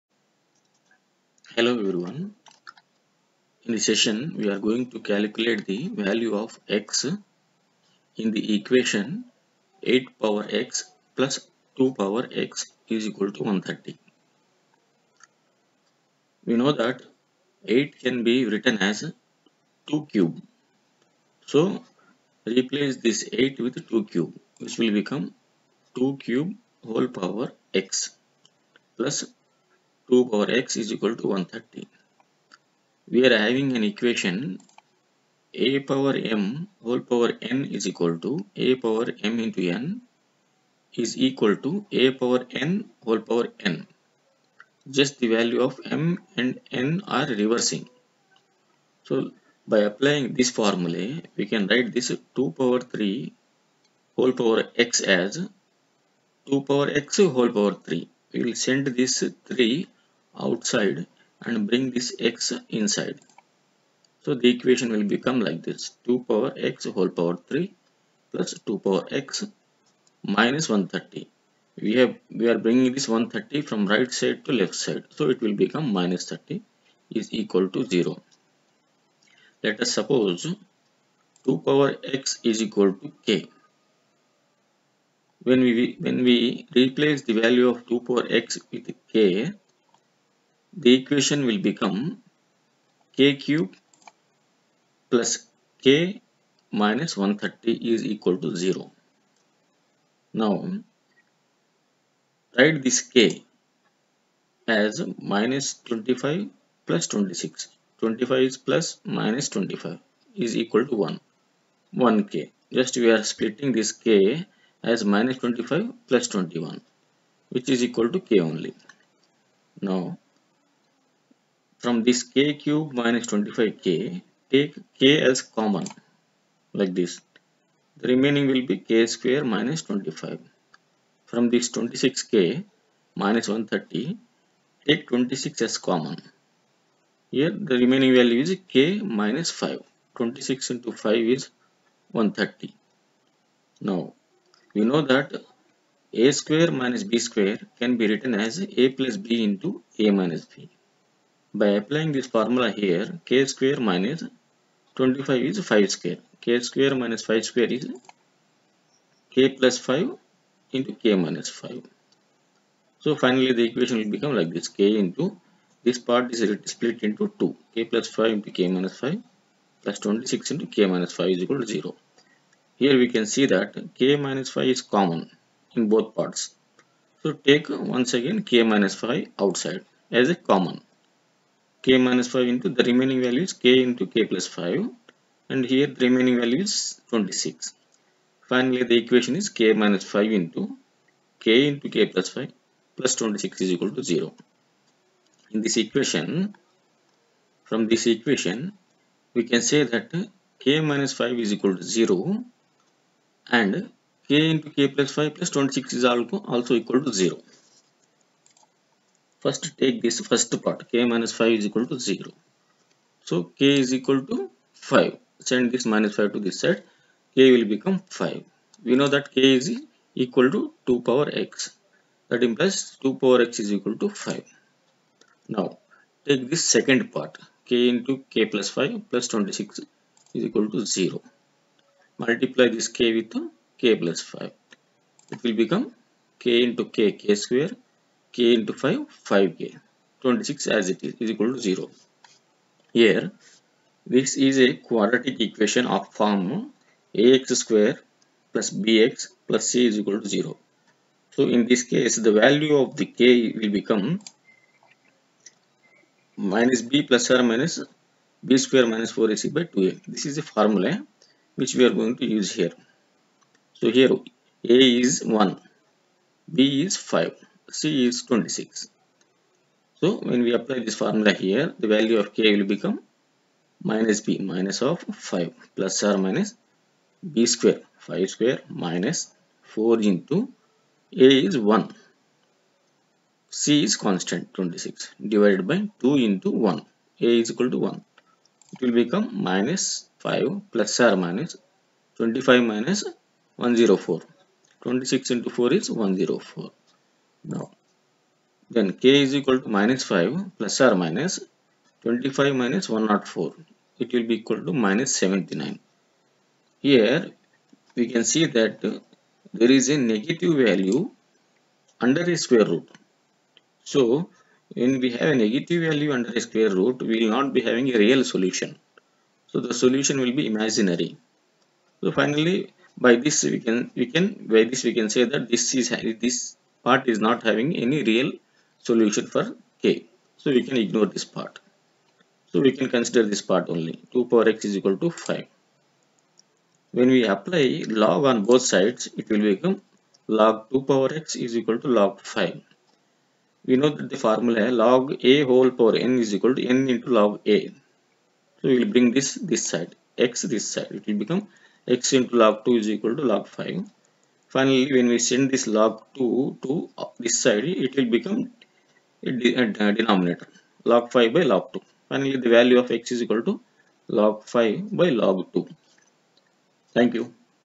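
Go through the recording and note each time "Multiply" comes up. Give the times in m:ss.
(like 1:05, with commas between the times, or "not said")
3:52.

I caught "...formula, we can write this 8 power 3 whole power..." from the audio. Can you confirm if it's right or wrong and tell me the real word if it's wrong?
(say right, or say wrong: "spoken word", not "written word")
wrong: "2", not "8".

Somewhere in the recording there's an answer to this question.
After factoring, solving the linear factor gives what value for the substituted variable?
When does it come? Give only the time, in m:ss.
3:33.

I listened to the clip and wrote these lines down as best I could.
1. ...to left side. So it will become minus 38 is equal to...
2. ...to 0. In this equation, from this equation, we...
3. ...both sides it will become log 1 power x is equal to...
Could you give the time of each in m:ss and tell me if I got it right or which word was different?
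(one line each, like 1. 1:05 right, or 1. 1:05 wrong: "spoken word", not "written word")
1. 1:14 wrong: "30", not "38"
2. 3:13 right
3. 5:38 wrong: "2", not "1".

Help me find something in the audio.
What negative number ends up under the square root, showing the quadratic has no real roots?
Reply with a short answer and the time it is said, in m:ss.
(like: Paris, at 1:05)
-79, at 5:04.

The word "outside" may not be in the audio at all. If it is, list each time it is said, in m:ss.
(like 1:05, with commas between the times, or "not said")
1:00, 2:59.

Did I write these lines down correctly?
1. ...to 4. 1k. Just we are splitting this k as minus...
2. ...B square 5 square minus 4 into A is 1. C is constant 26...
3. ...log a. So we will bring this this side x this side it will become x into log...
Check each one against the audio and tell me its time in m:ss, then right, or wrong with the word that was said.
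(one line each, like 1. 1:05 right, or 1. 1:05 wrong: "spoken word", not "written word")
1. 1:50 wrong: "1", not "4"
2. 4:37 right
3. 5:47 right.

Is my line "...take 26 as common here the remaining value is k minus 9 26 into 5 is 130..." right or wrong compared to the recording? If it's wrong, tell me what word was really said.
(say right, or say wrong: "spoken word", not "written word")
wrong: "5", not "9".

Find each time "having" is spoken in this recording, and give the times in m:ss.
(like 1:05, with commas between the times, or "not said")
0:33, 5:17, 5:27.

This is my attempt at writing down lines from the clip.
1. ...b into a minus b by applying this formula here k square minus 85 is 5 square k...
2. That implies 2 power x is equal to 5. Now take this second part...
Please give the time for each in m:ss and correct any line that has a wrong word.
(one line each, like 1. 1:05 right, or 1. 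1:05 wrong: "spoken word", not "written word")
1. 2:29 wrong: "25", not "85"
2. 3:42 right.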